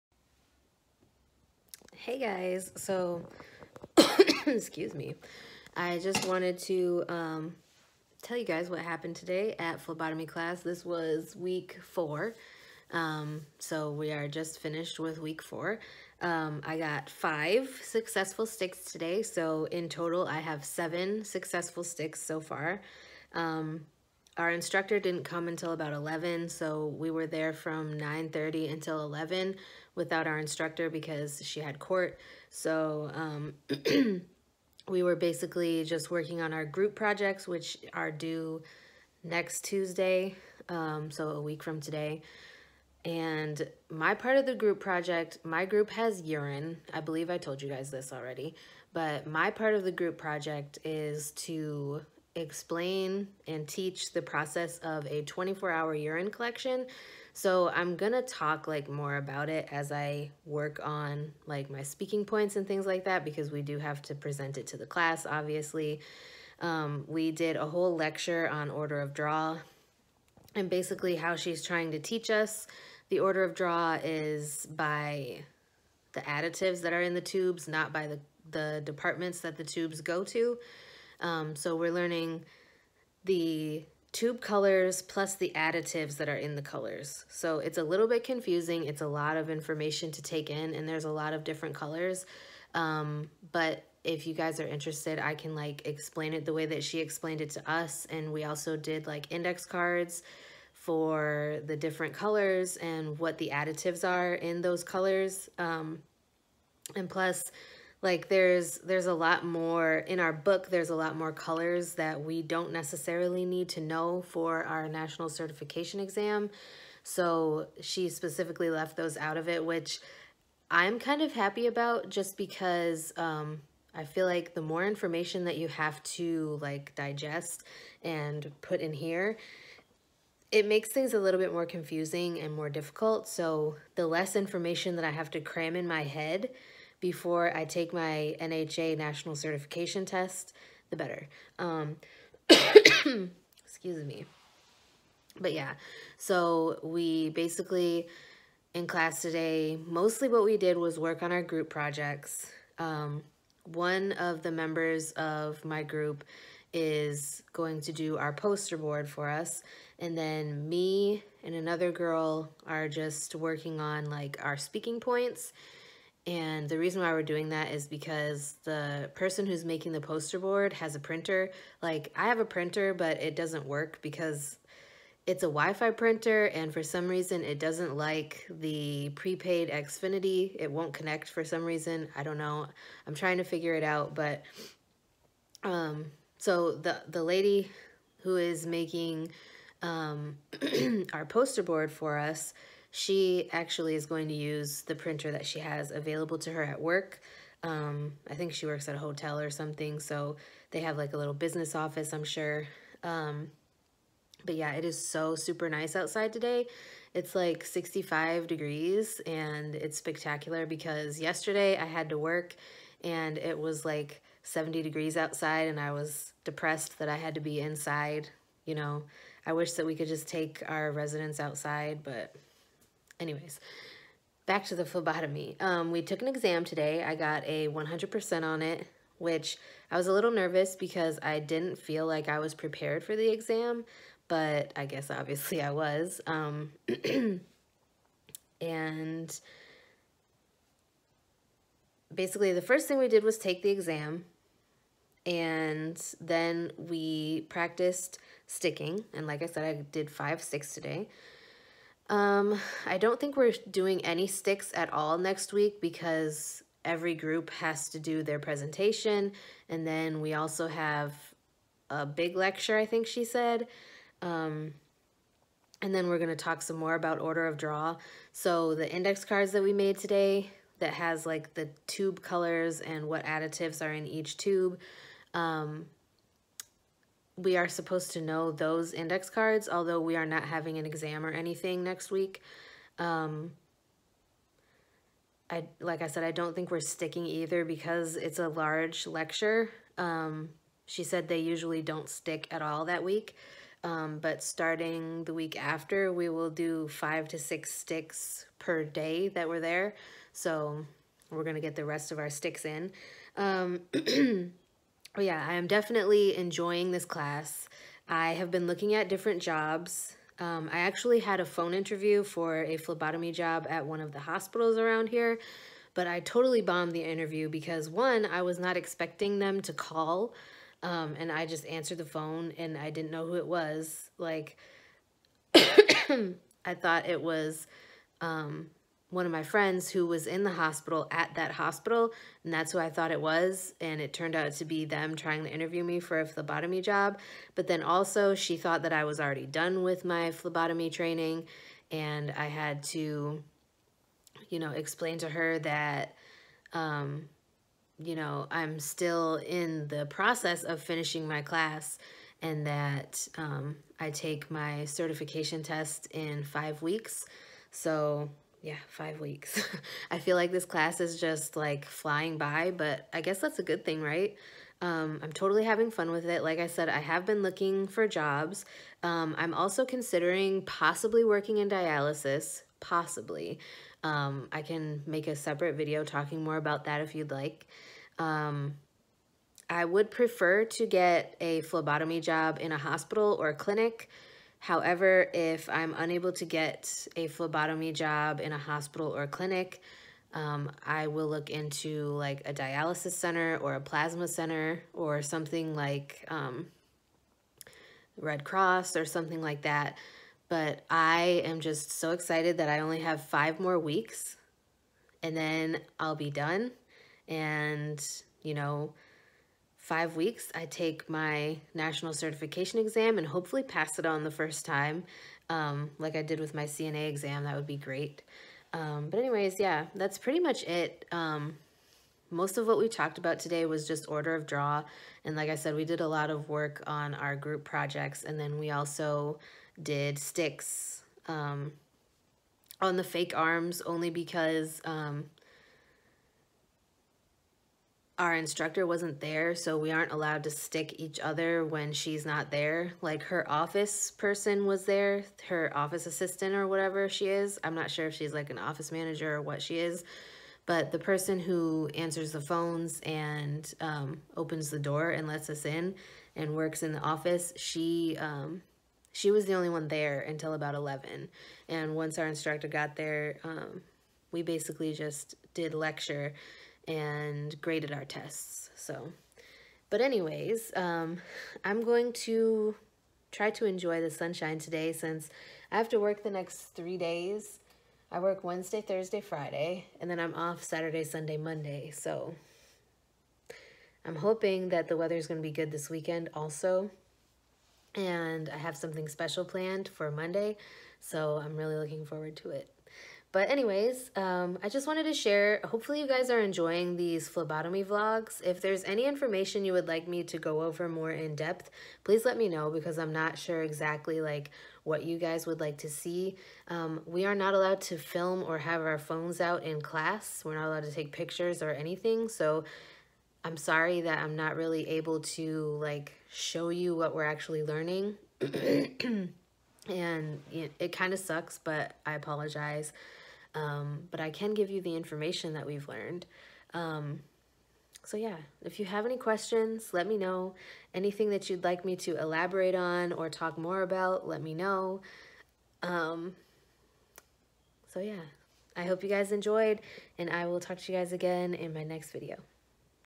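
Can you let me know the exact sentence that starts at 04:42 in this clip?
Um, I, like I said, I don't think we're sticking either because it's a large lecture.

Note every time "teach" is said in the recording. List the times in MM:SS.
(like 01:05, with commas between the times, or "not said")
00:53, 01:11.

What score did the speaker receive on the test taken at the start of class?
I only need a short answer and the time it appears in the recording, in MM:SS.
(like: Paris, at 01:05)
100%, at 03:47.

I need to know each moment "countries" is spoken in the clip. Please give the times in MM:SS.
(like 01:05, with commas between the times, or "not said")
not said.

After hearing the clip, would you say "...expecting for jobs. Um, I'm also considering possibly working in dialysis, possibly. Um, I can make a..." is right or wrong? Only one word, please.
wrong.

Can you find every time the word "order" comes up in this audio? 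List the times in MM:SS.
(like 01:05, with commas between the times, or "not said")
01:08, 01:13, 04:27, 07:04.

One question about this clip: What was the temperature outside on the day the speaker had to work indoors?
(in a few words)
70 degrees.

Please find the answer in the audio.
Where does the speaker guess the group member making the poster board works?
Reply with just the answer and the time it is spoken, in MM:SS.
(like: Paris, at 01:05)
A hotel, at 03:18.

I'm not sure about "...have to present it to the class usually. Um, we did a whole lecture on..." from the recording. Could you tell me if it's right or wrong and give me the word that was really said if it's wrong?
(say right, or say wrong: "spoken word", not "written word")
wrong: "obviously", not "usually".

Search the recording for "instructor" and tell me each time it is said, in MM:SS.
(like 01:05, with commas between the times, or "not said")
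00:24, 00:30, 07:18, 07:42.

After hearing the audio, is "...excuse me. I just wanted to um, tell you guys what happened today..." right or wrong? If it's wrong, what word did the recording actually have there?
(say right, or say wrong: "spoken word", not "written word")
right.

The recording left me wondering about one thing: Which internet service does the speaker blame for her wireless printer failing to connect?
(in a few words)
Prepaid Xfinity.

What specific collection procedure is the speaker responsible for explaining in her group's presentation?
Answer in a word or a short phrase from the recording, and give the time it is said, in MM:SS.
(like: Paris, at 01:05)
24-hour urine collection, at 00:55.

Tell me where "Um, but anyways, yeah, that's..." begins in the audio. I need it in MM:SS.
06:58.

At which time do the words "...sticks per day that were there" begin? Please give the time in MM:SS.
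04:57.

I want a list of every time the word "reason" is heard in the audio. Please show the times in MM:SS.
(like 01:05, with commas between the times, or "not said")
02:46, 02:57, 03:01.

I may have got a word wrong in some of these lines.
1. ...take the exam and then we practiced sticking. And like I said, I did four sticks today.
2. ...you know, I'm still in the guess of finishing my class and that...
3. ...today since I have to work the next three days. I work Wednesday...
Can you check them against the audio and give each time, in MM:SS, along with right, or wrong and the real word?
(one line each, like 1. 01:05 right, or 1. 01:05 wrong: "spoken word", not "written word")
1. 04:03 wrong: "five", not "four"
2. 05:47 wrong: "process", not "guess"
3. 07:54 right.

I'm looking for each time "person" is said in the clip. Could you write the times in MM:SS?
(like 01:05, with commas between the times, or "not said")
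02:49, 07:24, 07:30.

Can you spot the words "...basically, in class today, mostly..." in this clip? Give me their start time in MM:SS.
02:27.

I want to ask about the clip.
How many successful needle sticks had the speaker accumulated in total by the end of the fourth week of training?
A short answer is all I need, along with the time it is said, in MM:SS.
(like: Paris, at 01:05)
7, at 00:20.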